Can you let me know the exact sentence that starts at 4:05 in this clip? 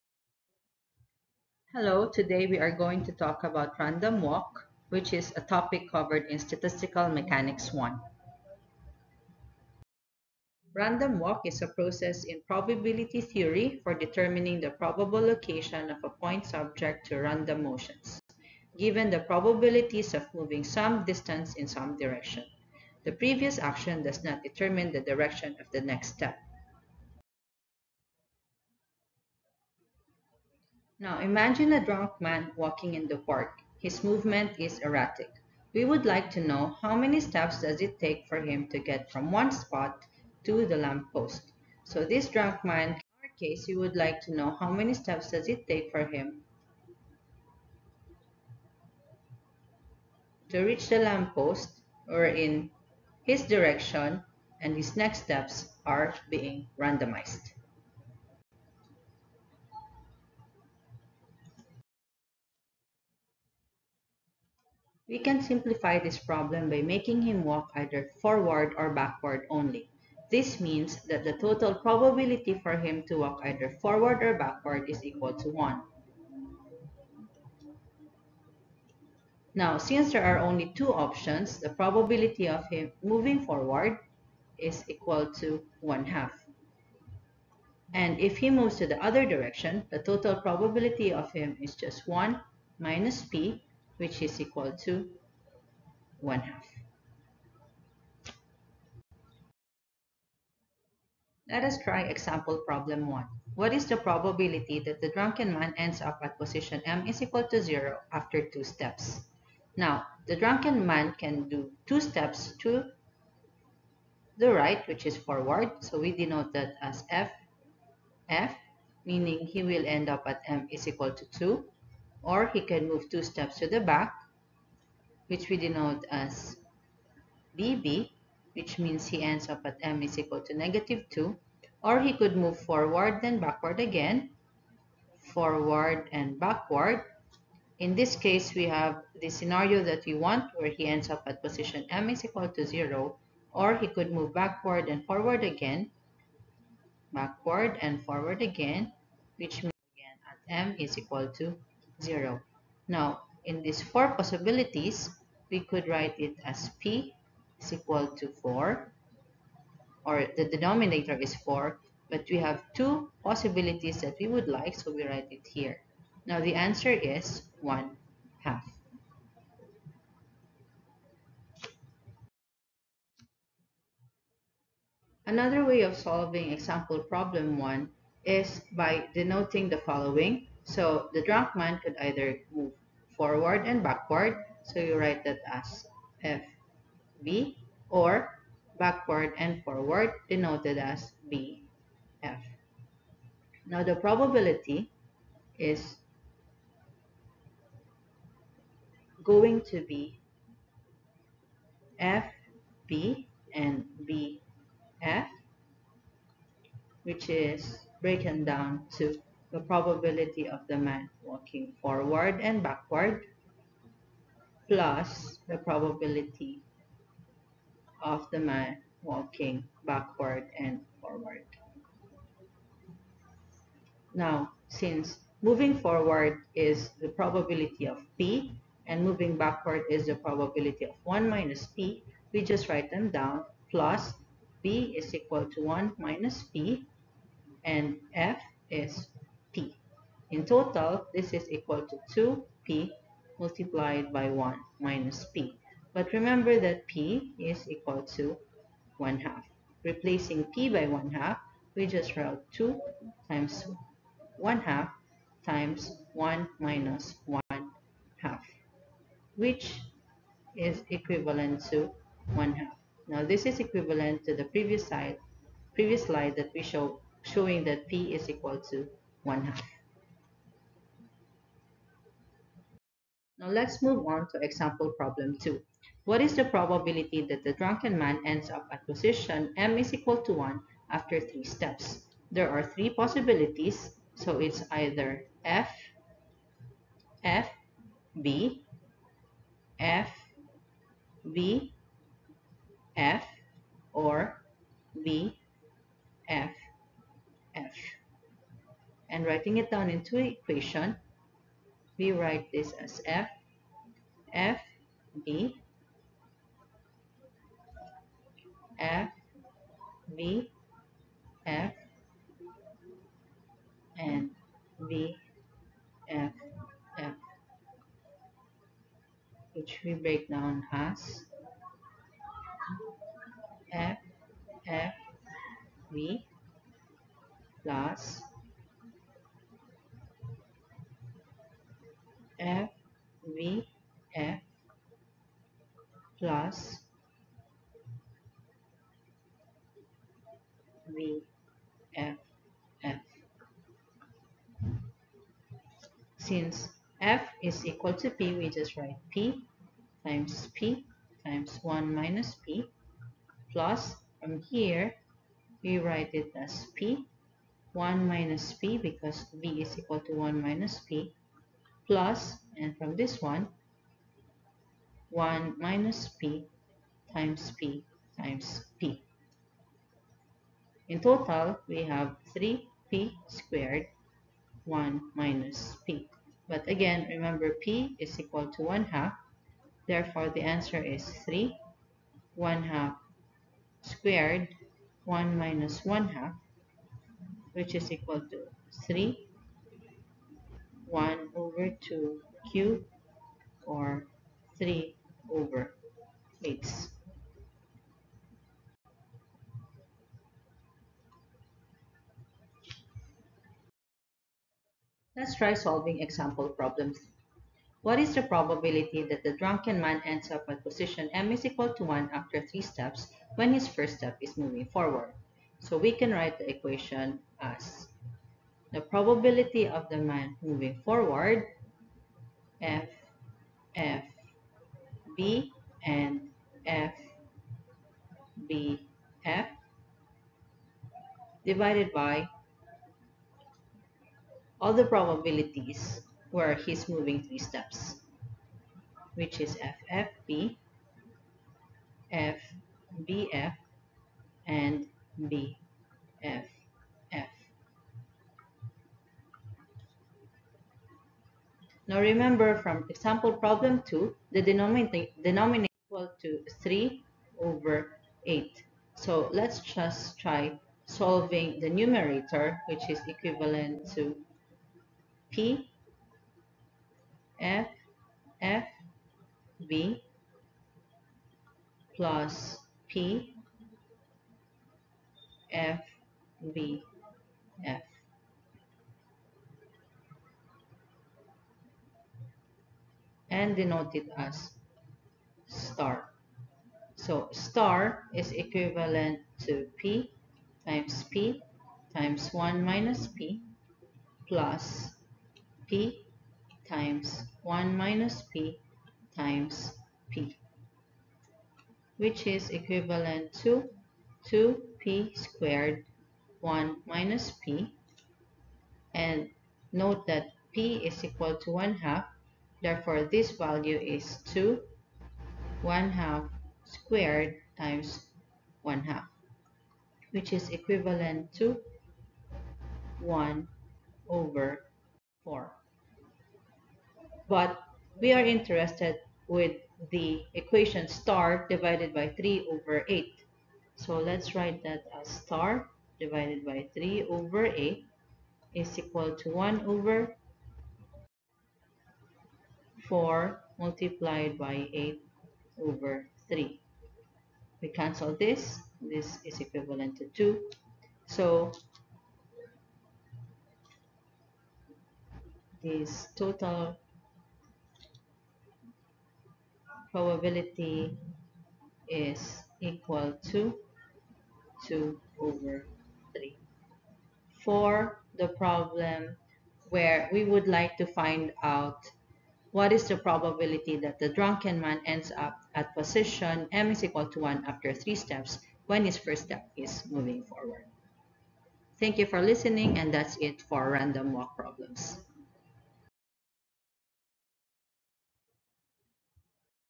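But remember that p is equal to 1 half.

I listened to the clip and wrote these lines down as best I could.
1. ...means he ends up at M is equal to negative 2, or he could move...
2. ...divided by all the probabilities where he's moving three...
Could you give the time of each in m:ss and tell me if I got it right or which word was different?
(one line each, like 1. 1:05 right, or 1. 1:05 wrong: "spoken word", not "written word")
1. 2:08 right
2. 7:11 right.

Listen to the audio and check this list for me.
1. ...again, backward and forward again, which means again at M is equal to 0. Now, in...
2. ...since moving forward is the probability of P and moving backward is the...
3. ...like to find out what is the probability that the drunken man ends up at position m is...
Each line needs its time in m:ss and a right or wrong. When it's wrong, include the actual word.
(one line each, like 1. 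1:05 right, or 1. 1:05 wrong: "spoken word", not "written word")
1. 2:25 right
2. 3:44 right
3. 9:30 right.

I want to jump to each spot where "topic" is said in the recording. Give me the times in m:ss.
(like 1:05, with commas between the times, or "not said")
0:05.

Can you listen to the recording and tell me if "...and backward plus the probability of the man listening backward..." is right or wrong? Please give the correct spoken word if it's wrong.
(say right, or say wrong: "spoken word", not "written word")
wrong: "walking", not "listening".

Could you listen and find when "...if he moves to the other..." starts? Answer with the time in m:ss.
1:28.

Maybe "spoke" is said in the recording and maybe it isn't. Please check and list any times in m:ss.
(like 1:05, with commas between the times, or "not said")
not said.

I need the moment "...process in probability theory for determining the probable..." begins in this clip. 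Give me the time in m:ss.
0:11.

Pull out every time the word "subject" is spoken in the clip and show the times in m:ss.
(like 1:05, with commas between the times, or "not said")
0:16.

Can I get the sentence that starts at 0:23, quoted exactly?
The previous action does not determine the direction of the next step.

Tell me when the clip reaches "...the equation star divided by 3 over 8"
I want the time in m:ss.
8:49.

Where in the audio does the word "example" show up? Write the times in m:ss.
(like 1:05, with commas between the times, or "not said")
1:42, 2:56, 4:34, 6:46, 7:32.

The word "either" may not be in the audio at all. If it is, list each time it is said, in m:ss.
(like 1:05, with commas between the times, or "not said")
1:07, 1:13, 3:01, 4:44.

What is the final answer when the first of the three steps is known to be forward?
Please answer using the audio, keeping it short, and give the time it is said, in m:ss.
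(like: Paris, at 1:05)
2/3, at 9:24.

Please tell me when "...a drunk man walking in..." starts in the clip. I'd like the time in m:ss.
0:31.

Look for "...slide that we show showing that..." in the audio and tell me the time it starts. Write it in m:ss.
4:26.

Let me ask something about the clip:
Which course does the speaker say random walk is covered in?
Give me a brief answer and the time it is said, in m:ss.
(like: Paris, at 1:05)
Statistical Mechanics 1, at 0:06.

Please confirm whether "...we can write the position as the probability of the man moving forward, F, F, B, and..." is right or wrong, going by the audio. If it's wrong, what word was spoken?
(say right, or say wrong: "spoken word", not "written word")
wrong: "equation", not "position".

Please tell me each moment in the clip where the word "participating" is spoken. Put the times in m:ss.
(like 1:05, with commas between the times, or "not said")
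not said.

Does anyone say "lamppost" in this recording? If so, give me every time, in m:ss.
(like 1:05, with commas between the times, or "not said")
0:40, 0:50.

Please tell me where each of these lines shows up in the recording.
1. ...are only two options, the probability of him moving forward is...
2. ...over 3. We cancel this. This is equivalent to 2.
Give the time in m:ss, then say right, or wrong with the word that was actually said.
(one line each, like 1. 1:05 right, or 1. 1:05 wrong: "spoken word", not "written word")
1. 1:20 right
2. 9:05 right.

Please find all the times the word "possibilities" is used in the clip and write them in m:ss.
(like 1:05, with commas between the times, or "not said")
2:34, 2:43, 4:42.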